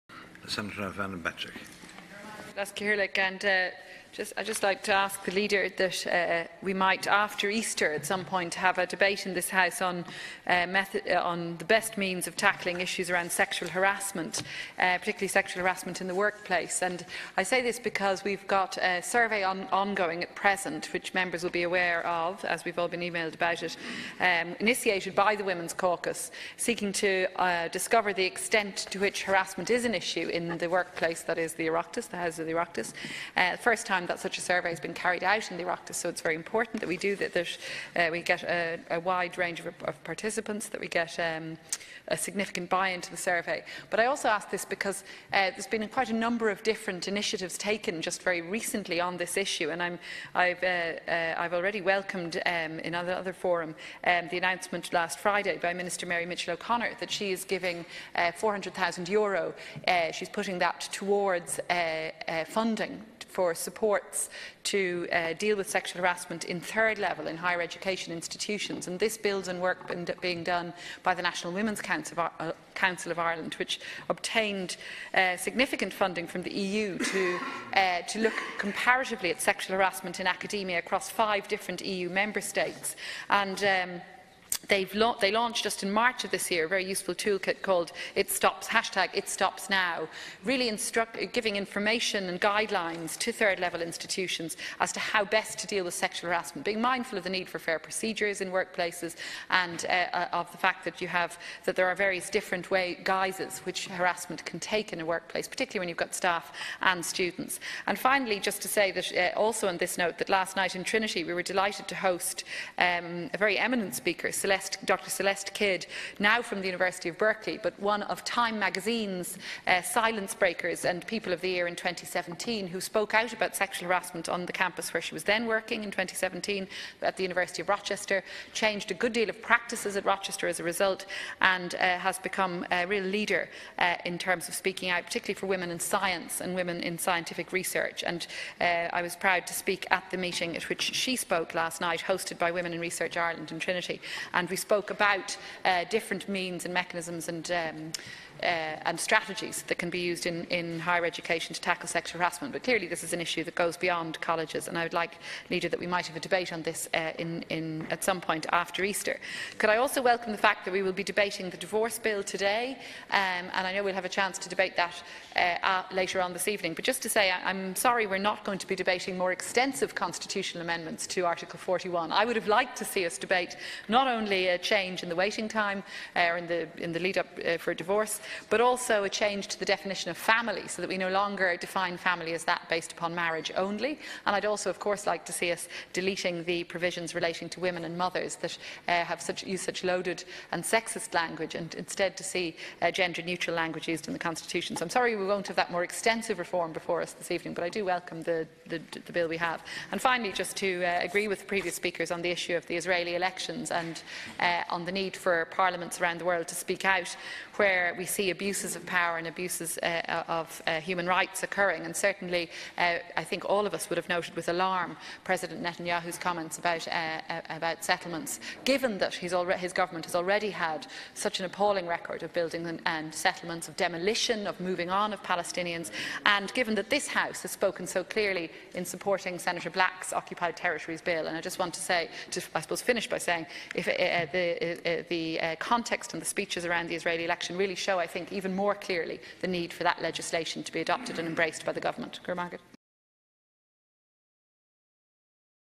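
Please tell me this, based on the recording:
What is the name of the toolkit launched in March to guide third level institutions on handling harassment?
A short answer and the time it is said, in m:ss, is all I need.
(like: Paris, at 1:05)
It Stops Now, at 1:28.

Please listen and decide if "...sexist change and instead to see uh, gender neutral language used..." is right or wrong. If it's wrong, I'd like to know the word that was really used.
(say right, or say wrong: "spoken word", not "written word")
wrong: "language", not "change".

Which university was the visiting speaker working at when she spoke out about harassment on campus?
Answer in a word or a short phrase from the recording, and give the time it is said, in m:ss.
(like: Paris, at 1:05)
University of Rochester, at 2:07.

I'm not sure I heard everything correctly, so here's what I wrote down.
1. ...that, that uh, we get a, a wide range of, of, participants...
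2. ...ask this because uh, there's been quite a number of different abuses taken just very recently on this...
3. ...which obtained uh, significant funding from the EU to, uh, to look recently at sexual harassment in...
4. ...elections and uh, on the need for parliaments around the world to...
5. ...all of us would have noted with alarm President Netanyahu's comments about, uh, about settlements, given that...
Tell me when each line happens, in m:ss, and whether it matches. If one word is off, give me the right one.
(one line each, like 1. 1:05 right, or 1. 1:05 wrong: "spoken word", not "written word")
1. 0:37 right
2. 0:44 wrong: "initiatives", not "abuses"
3. 1:13 wrong: "comparatively", not "recently"
4. 3:23 right
5. 3:33 right.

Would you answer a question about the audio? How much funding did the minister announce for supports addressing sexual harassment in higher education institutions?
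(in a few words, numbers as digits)
€400,000.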